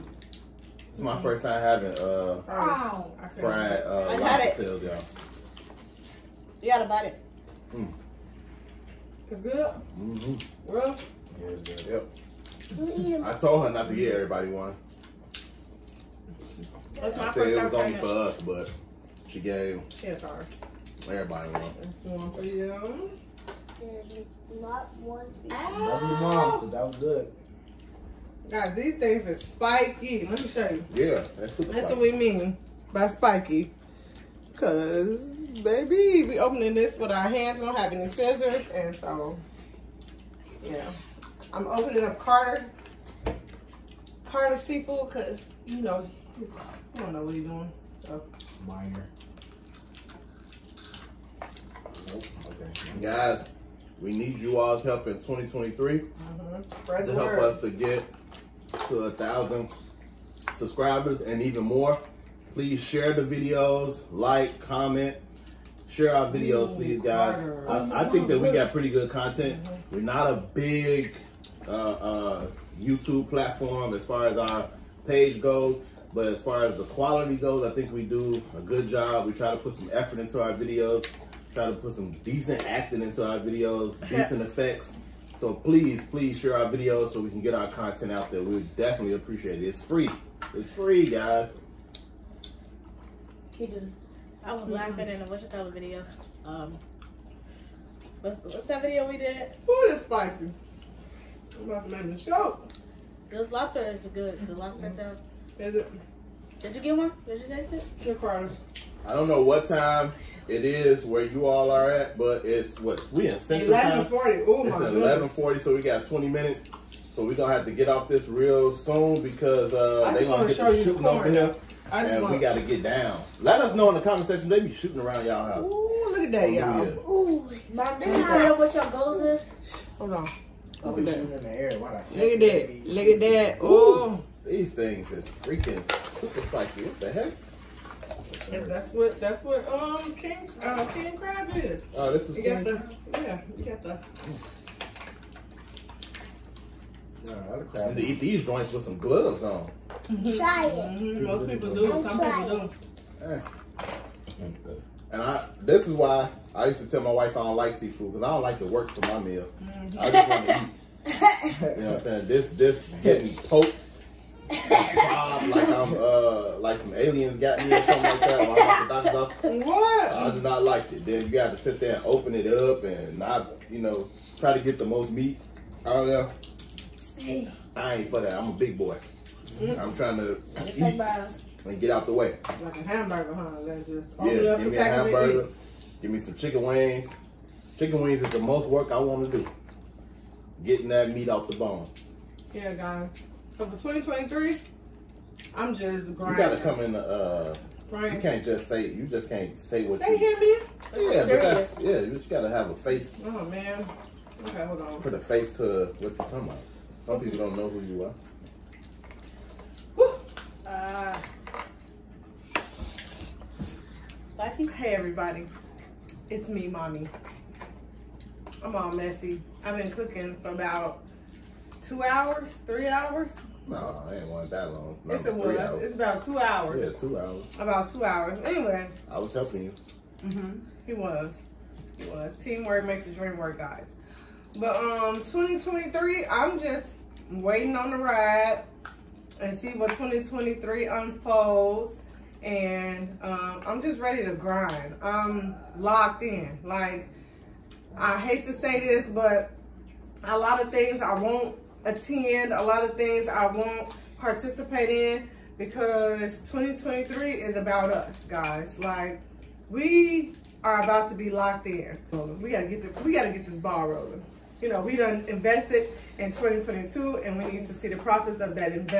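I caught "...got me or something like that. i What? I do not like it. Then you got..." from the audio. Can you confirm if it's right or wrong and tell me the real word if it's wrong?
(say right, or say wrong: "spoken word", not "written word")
right.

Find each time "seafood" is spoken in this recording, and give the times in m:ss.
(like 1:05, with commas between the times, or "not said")
0:44, 2:37.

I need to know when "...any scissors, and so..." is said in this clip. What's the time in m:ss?
0:37.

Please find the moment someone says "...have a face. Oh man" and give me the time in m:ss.
3:22.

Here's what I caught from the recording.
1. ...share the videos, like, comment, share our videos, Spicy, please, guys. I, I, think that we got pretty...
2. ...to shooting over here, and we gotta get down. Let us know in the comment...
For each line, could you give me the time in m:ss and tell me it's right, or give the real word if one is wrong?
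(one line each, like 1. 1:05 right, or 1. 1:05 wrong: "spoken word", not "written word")
1. 1:02 wrong: "Ooh", not "Spicy"
2. 2:00 right.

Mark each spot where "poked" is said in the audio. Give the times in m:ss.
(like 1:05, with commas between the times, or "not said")
2:43.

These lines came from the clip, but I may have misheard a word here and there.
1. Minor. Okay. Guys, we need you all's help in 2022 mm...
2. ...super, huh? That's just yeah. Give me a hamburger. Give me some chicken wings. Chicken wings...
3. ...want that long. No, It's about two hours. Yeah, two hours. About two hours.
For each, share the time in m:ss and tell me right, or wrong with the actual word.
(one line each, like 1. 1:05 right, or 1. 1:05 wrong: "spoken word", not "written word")
1. 0:48 wrong: "2023", not "2022"
2. 3:02 wrong: "hamburger", not "super"
3. 3:44 right.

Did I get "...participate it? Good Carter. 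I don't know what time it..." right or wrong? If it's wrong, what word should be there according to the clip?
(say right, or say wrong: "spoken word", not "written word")
wrong: "taste", not "participate".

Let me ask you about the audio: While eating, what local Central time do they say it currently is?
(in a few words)
11:40.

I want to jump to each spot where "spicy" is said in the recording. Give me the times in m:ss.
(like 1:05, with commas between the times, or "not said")
1:40, 3:34.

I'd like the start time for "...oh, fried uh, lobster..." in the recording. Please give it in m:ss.
0:02.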